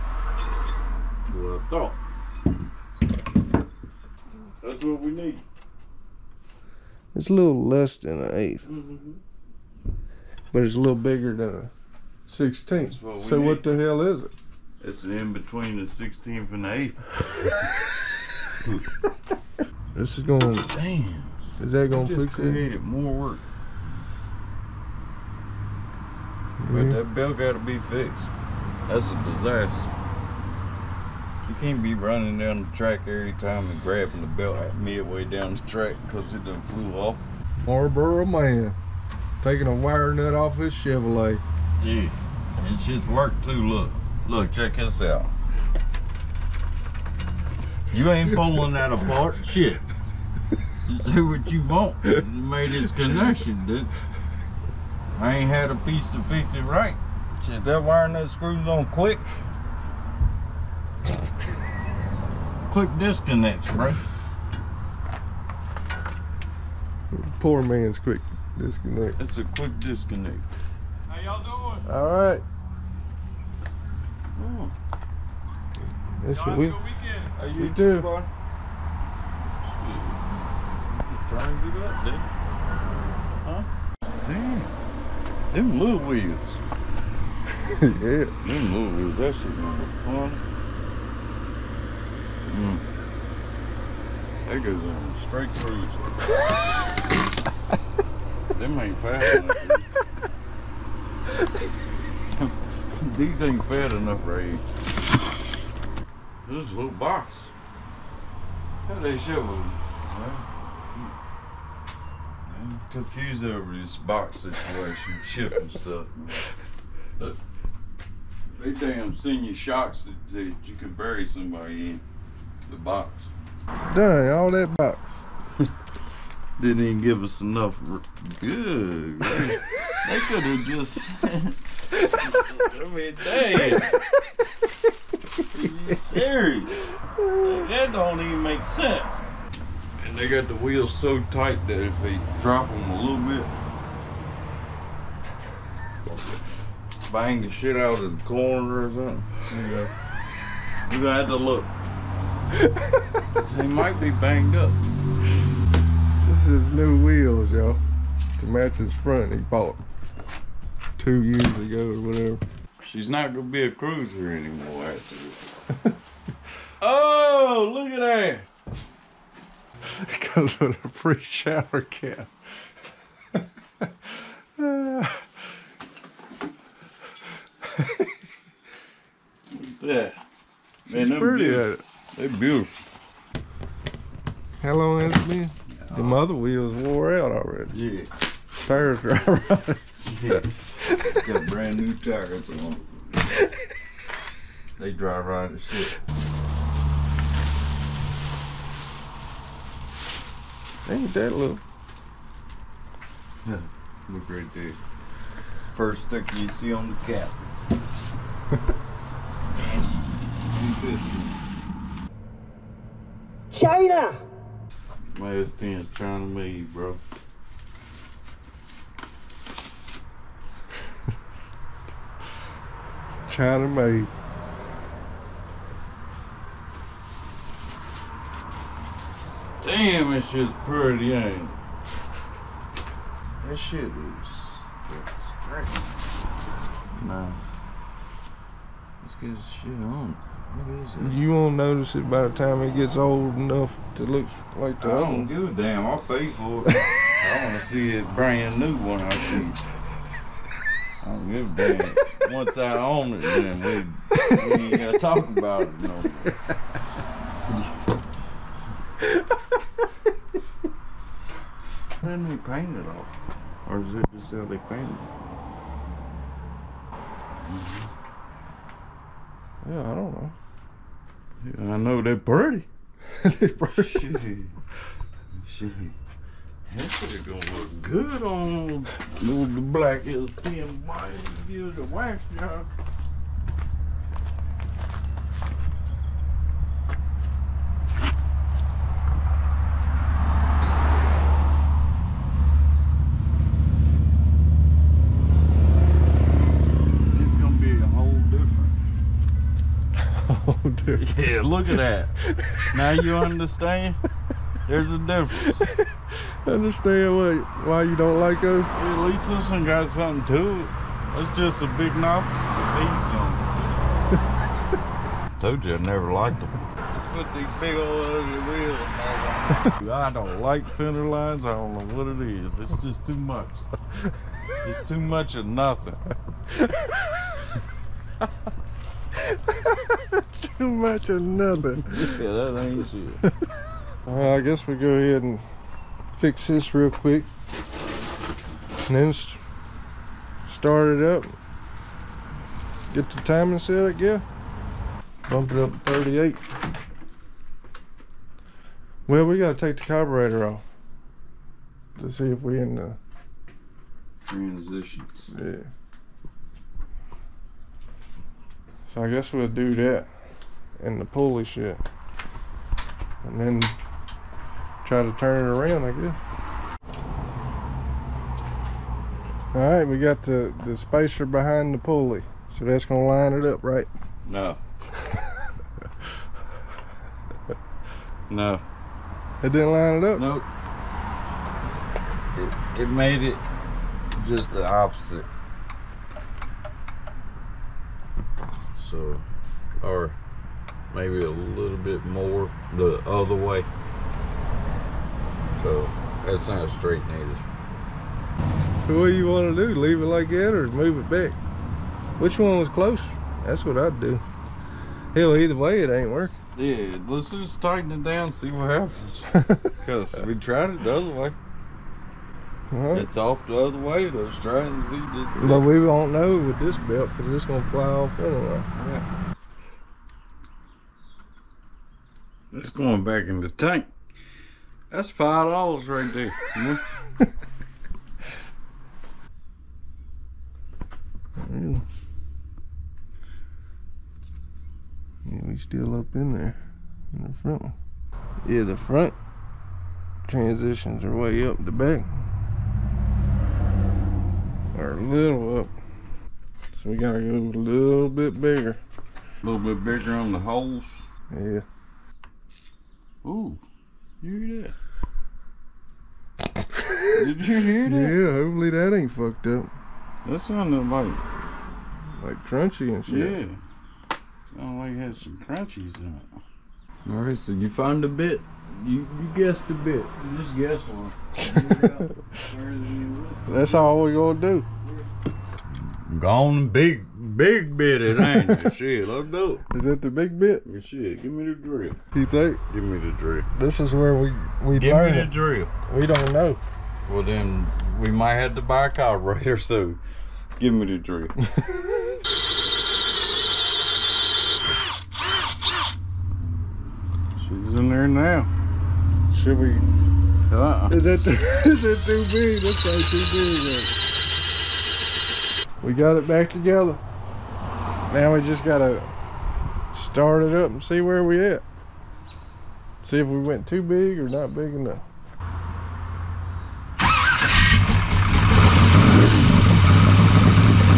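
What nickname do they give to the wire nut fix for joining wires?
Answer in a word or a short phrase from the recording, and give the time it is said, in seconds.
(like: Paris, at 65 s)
Poor man's quick disconnect, at 67 s.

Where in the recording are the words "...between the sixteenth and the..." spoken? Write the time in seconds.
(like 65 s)
15 s.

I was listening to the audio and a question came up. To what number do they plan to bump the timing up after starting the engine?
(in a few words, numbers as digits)
38.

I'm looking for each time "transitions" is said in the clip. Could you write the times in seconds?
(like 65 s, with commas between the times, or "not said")
354 s, 440 s.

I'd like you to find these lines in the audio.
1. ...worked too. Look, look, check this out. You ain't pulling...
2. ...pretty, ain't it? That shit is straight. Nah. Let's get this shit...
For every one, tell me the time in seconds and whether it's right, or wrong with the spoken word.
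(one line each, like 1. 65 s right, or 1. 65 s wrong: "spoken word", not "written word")
1. 43 s right
2. 230 s right.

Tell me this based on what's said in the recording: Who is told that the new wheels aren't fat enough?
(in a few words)
Ray.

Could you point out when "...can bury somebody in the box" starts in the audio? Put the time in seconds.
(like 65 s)
120 s.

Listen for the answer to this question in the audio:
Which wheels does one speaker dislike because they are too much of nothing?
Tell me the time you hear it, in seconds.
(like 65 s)
320 s.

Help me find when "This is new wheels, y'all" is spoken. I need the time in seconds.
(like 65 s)
156 s.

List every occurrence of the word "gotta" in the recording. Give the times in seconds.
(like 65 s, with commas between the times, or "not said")
349 s, 446 s, 508 s.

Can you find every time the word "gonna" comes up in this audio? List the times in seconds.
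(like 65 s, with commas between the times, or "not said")
89 s, 163 s, 277 s, 474 s.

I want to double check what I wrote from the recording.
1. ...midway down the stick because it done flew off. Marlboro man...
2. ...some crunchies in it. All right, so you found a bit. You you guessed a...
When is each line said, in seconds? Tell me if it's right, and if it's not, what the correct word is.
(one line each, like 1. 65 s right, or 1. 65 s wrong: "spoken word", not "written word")
1. 34 s wrong: "track", not "stick"
2. 465 s right.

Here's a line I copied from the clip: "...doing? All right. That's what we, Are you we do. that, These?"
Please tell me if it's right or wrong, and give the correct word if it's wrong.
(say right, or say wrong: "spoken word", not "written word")
wrong: "Bar", not "These".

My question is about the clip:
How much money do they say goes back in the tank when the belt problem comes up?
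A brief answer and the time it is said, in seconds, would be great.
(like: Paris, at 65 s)
five dollars, at 425 s.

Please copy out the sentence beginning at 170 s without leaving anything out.
It comes with a free shower cap.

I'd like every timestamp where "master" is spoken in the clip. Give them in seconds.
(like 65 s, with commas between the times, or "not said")
not said.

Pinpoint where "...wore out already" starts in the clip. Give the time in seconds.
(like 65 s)
186 s.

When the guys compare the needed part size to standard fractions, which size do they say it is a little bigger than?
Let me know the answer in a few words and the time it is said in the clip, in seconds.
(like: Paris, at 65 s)
a sixteenth, at 11 s.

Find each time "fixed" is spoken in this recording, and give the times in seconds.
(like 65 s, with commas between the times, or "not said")
27 s.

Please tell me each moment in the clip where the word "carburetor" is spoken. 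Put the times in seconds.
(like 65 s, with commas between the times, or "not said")
349 s, 488 s.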